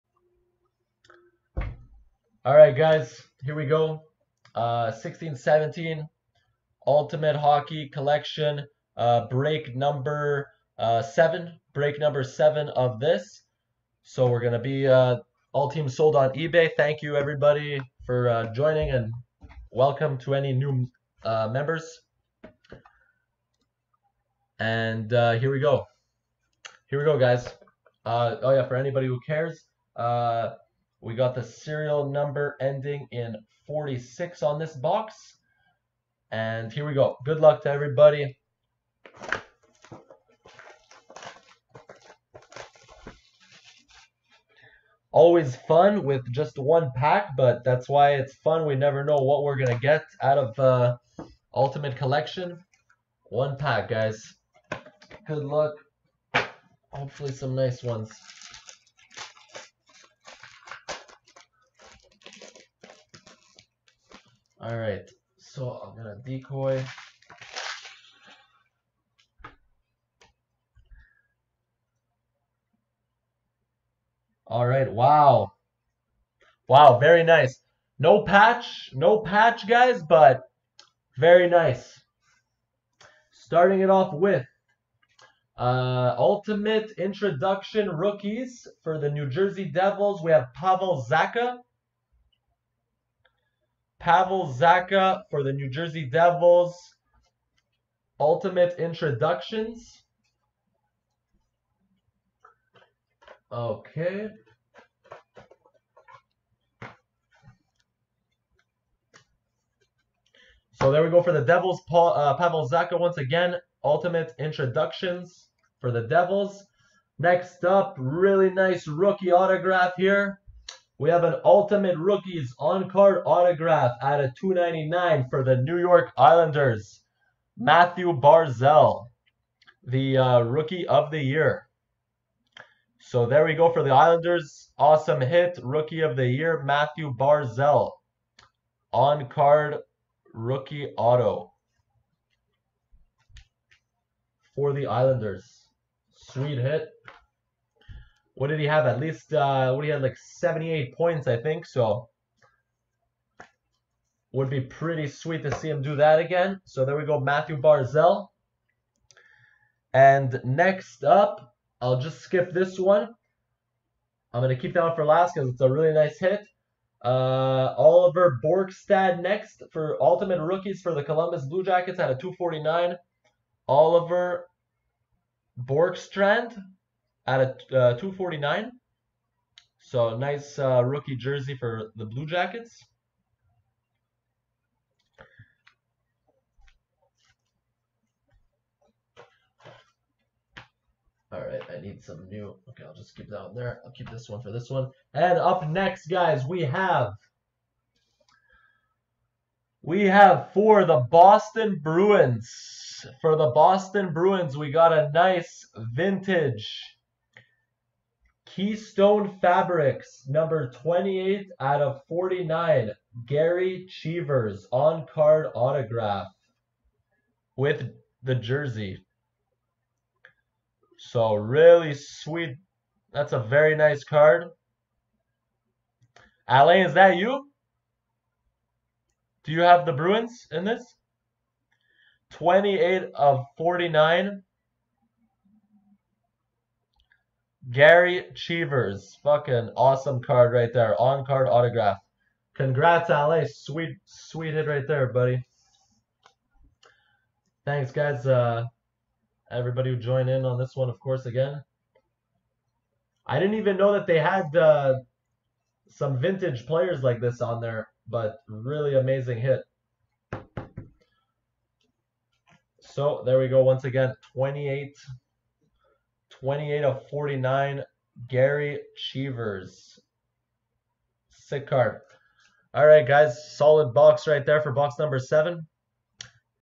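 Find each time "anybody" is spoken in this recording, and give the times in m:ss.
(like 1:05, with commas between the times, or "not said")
0:28.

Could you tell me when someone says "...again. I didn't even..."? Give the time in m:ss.
4:11.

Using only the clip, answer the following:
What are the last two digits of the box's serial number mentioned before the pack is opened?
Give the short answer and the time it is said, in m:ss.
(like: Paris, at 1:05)
46, at 0:32.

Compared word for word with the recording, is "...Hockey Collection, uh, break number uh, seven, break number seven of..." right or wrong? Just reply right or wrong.
right.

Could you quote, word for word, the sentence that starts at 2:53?
Oliver Bjorkstrand, at a uh, 249.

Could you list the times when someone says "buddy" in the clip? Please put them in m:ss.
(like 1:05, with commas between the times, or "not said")
4:05.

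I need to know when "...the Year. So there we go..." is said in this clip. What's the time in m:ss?
2:11.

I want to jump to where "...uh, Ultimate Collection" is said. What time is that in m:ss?
0:50.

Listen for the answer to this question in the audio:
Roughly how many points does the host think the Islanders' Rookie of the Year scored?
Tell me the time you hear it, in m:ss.
2:30.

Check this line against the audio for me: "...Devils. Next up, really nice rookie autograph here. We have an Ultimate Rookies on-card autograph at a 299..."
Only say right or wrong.
right.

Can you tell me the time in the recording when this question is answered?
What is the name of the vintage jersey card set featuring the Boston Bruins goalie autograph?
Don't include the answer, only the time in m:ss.
3:28.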